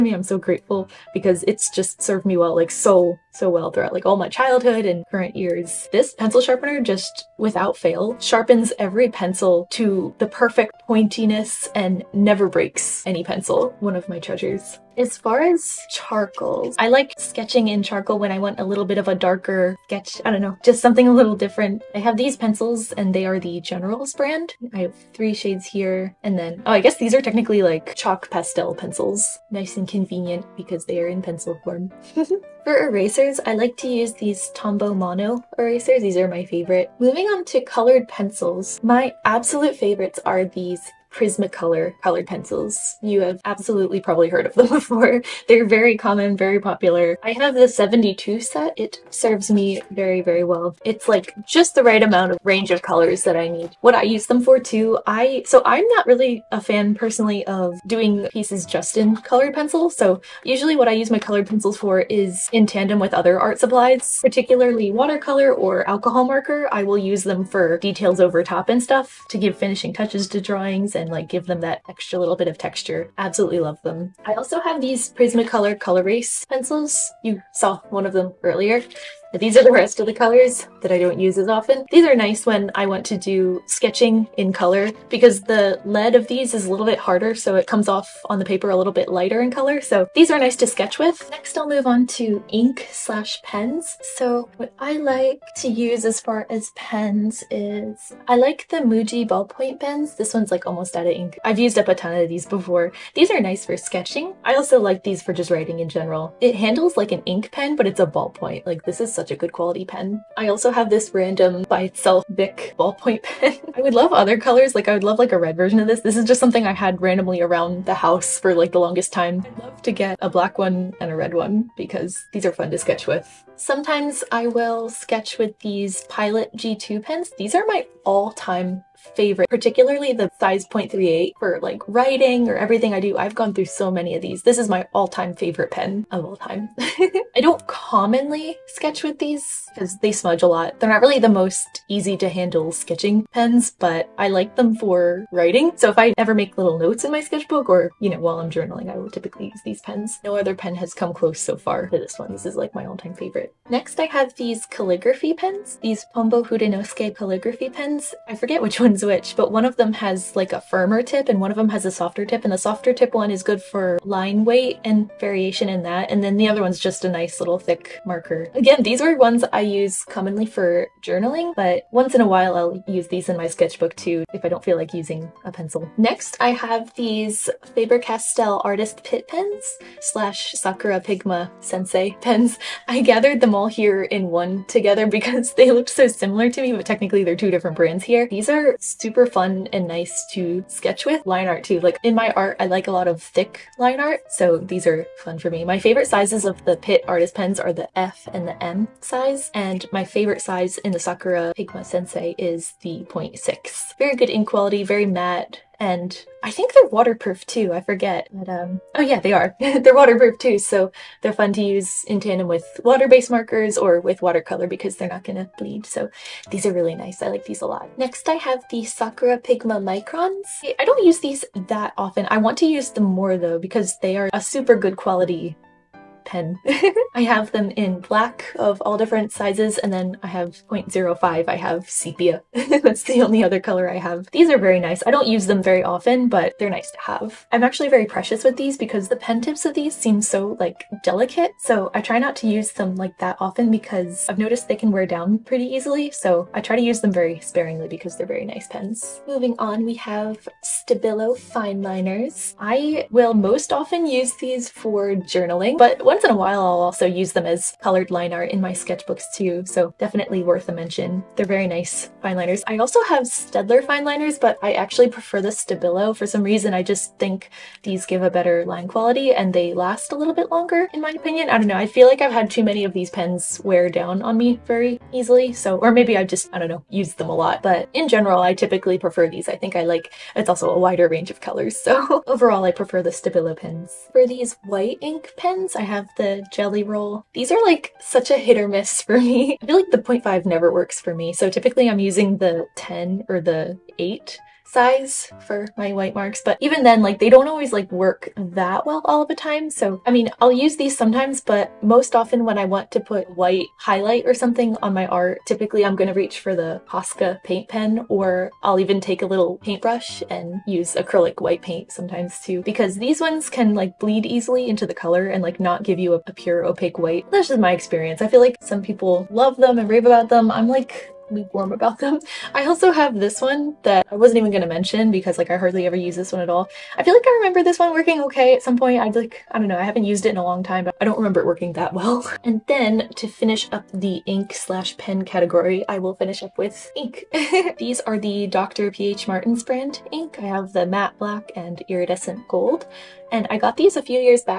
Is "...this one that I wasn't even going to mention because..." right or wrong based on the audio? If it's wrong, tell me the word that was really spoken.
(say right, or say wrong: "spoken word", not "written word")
right.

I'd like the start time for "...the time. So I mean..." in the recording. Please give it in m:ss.
4:59.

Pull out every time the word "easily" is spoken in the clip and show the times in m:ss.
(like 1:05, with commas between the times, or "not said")
4:05, 4:35, 5:14.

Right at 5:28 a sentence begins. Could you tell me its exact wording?
I'd like, I don't know, I haven't used it in a long time, but I don't remember it working that well.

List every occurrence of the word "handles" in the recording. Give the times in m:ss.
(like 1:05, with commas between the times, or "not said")
1:46, 2:22.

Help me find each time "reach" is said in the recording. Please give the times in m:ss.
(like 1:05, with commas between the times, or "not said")
5:06.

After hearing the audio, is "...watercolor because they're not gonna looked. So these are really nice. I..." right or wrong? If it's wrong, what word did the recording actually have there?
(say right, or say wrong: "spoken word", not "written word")
wrong: "bleed", not "looked".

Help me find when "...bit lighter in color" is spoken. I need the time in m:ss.
1:28.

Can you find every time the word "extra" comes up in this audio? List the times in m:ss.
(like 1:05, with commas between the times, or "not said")
1:11.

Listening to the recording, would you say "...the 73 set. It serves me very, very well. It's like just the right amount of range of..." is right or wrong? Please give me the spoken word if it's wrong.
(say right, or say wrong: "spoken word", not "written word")
wrong: "72", not "73".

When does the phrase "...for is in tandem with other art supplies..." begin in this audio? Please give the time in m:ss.
1:01.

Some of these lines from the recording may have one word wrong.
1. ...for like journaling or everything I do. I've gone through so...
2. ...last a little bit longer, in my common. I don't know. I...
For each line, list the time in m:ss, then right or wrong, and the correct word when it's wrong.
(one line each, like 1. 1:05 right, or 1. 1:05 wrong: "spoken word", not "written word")
1. 2:11 wrong: "writing", not "journaling"
2. 4:29 wrong: "opinion", not "common".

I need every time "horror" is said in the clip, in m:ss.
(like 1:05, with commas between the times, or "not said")
not said.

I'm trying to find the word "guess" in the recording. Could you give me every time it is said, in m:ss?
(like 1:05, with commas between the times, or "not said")
0:26.